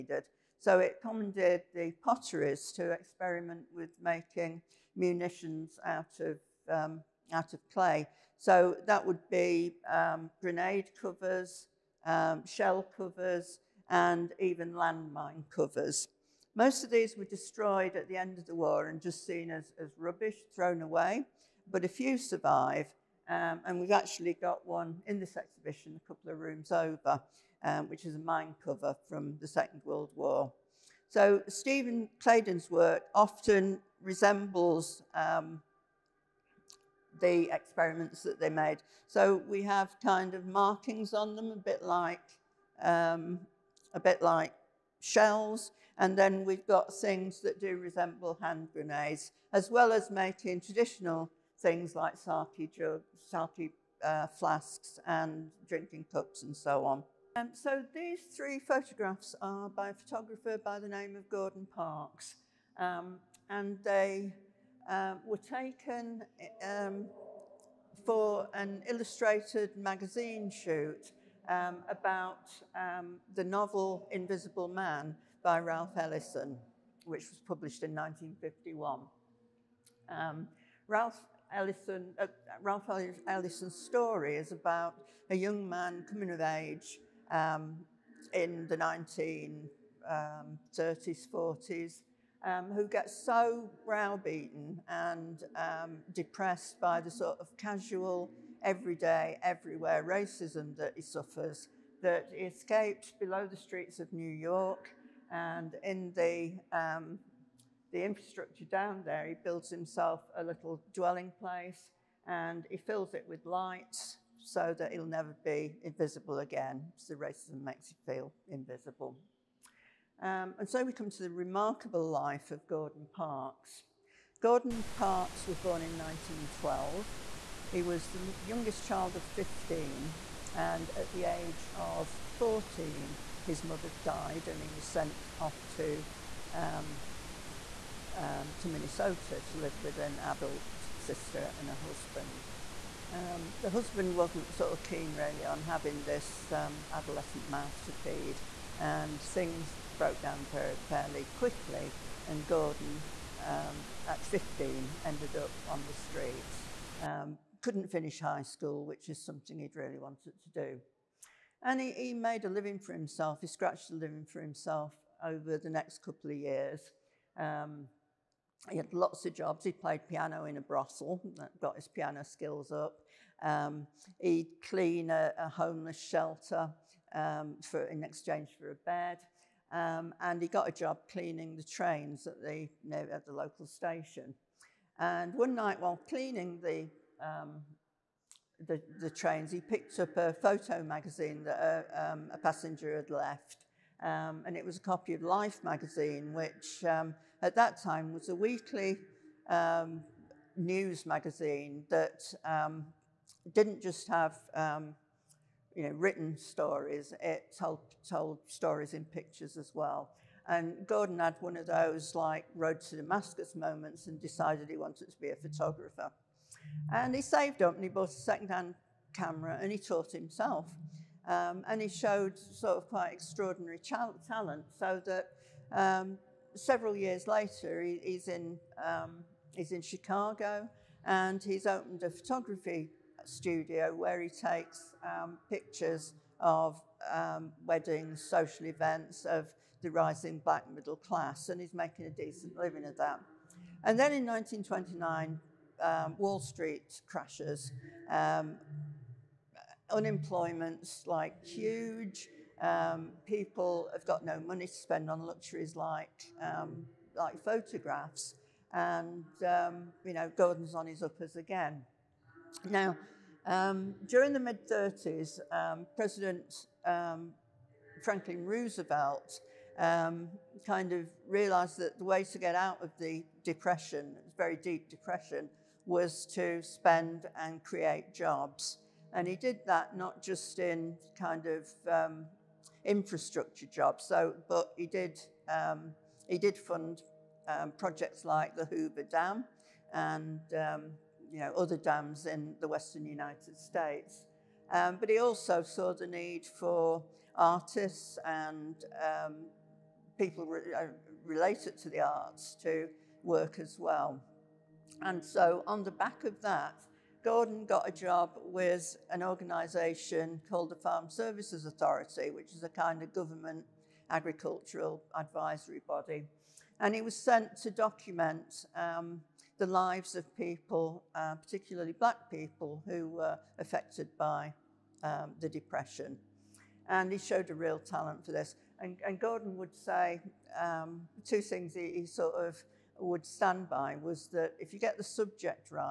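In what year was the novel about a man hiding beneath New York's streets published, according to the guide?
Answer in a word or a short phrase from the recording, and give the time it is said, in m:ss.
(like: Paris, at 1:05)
1951, at 1:17.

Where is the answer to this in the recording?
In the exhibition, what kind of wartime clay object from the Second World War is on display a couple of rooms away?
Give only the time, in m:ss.
0:28.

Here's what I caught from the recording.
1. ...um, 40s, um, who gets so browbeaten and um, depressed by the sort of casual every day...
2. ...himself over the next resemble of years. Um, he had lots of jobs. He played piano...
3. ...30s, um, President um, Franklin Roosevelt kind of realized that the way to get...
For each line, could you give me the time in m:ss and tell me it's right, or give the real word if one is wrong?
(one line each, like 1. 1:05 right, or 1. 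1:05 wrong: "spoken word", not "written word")
1. 1:30 right
2. 2:44 wrong: "couple", not "resemble"
3. 4:24 right.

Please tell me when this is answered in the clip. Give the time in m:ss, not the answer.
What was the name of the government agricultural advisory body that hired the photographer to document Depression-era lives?
5:10.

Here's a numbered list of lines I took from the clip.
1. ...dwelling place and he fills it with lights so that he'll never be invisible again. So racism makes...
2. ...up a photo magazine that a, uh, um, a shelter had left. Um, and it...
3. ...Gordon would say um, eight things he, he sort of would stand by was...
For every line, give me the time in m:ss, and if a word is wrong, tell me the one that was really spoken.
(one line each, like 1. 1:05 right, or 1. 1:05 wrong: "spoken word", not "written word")
1. 1:50 right
2. 3:09 wrong: "passenger", not "shelter"
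3. 5:29 wrong: "two", not "eight".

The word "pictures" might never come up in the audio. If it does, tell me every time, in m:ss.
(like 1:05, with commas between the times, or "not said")
3:29, 3:55.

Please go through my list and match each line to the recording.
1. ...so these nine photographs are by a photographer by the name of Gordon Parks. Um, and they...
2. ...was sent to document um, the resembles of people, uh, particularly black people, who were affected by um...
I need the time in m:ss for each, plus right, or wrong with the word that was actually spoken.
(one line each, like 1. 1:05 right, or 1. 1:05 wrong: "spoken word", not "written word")
1. 0:57 wrong: "three", not "nine"
2. 5:17 wrong: "lives", not "resembles".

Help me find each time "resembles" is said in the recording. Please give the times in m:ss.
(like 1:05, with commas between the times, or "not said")
0:34, 0:47.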